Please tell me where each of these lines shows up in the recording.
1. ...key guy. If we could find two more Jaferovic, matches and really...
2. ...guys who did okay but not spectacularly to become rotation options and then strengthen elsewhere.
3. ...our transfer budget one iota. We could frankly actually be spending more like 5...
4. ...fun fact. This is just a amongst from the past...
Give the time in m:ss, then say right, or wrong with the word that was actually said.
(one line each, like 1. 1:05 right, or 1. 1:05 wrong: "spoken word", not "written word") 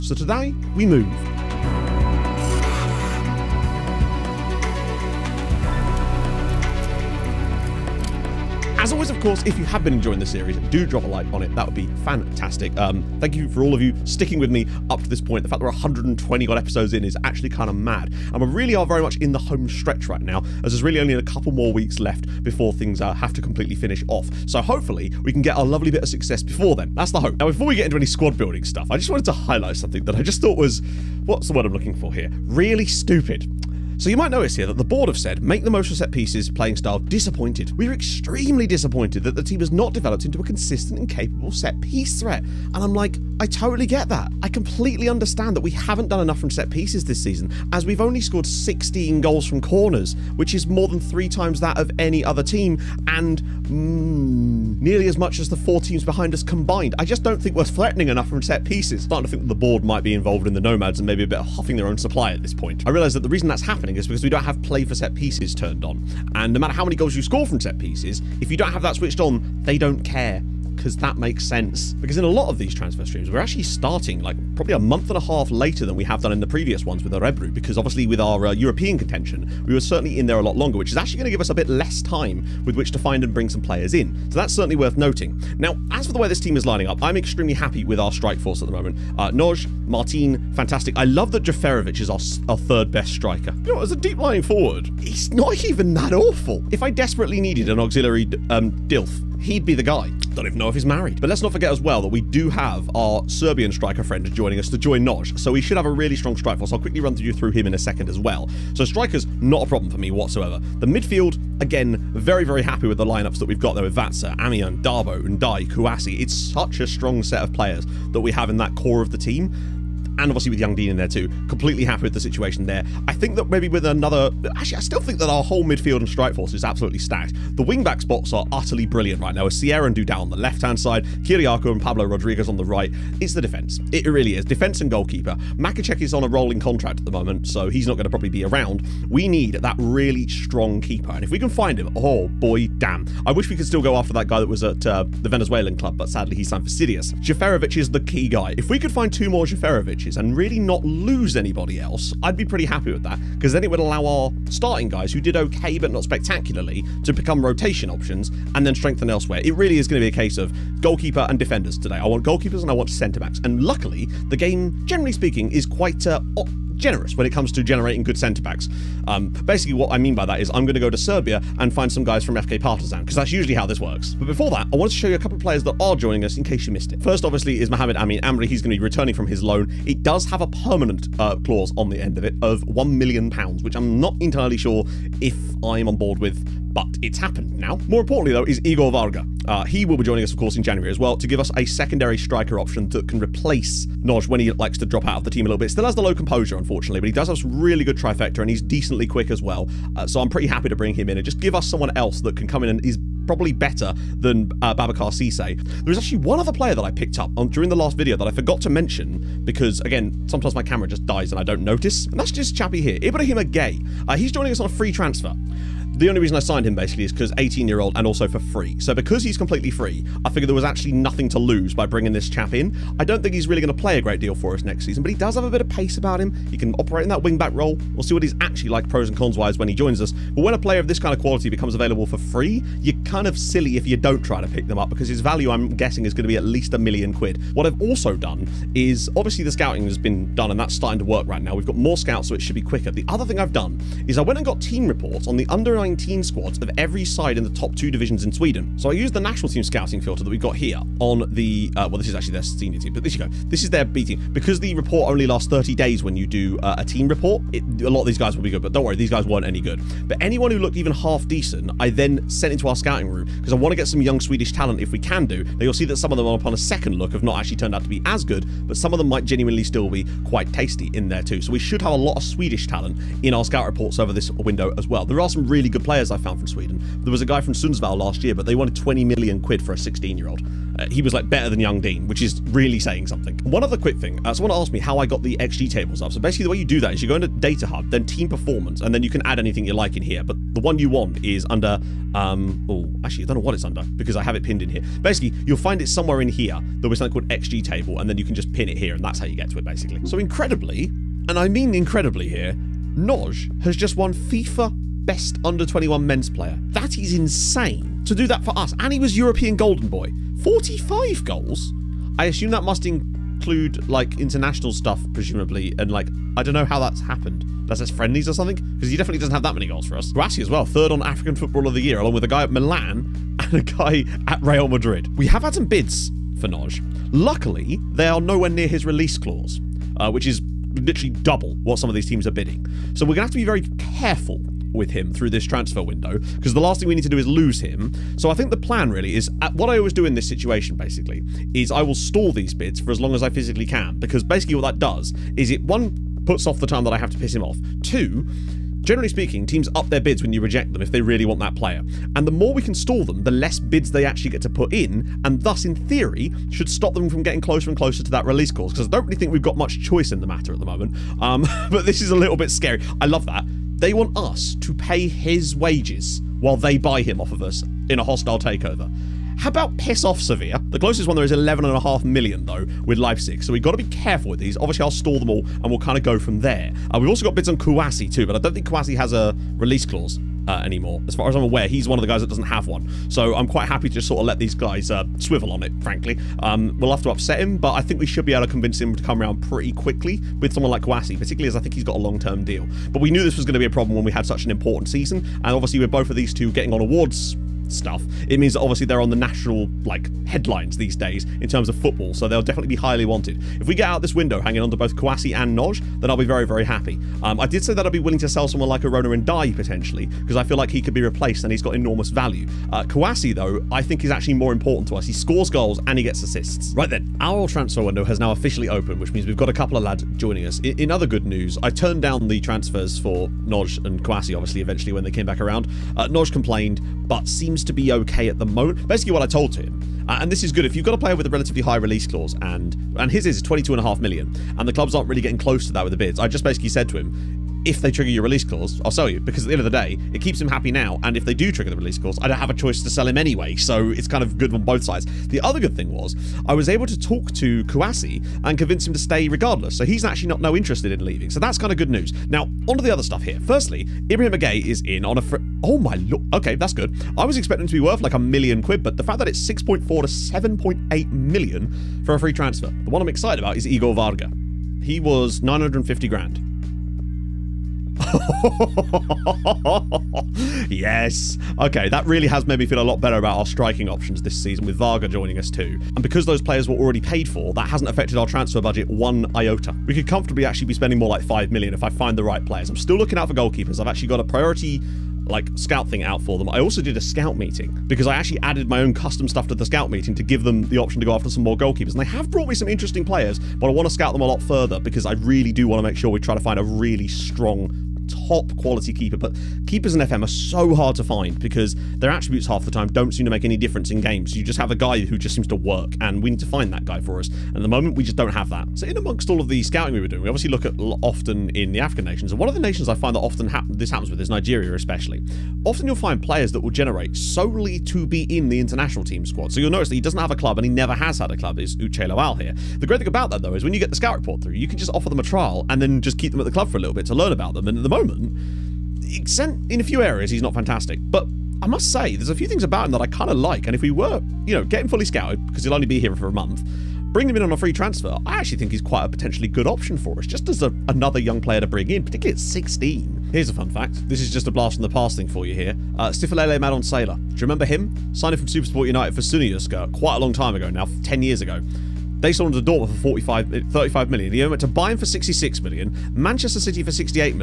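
1. 2:27 right
2. 2:34 right
3. 7:58 wrong: "comfortably", not "frankly"
4. 9:03 wrong: "blast", not "amongst".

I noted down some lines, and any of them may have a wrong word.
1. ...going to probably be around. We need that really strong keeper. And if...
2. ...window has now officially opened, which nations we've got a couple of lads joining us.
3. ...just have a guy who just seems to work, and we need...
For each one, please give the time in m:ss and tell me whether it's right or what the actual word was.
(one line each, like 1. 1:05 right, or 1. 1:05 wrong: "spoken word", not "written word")
1. 2:17 right
2. 6:57 wrong: "means", not "nations"
3. 8:24 right.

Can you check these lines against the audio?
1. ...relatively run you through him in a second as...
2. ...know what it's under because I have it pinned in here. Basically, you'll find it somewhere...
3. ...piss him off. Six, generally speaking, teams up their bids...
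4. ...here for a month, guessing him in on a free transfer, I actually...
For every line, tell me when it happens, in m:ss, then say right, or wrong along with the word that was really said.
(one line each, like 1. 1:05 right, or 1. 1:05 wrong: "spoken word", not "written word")
1. 1:46 wrong: "quickly", not "relatively"
2. 4:53 right
3. 5:47 wrong: "Two", not "Six"
4. 8:55 wrong: "bring", not "guessing".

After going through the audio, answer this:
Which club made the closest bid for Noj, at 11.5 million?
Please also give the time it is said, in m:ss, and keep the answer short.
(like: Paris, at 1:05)
Leipzig, at 6:12.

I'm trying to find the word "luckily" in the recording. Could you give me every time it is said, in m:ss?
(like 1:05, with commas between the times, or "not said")
2:43, 5:27.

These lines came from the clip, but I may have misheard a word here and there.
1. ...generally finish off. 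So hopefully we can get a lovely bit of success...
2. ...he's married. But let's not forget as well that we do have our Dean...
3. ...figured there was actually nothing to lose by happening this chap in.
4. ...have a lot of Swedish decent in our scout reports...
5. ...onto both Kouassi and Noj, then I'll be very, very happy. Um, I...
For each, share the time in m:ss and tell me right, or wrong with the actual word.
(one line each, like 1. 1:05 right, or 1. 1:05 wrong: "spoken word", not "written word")
1. 0:23 wrong: "completely", not "generally"
2. 1:40 wrong: "Serbian", not "Dean"
3. 3:40 wrong: "bringing", not "happening"
4. 4:31 wrong: "talent", not "decent"
5. 6:44 right.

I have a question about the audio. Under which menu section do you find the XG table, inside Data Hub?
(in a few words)
Team Performance.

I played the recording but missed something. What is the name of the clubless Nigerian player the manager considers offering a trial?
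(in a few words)
Uche Lawal.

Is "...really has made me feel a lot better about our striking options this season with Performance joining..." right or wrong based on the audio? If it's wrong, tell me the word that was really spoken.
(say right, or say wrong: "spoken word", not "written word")
wrong: "Varga", not "Performance".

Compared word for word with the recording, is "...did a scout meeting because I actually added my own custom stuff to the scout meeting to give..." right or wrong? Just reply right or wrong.
right.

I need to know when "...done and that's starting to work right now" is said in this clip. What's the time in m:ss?
4:00.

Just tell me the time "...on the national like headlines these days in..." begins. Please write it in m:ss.
6:39.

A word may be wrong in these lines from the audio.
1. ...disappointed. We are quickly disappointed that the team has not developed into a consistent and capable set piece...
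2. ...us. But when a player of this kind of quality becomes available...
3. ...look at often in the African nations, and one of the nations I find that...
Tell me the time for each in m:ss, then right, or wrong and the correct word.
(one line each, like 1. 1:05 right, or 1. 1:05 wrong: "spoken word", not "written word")
1. 0:37 wrong: "extremely", not "quickly"
2. 3:50 right
3. 8:30 right.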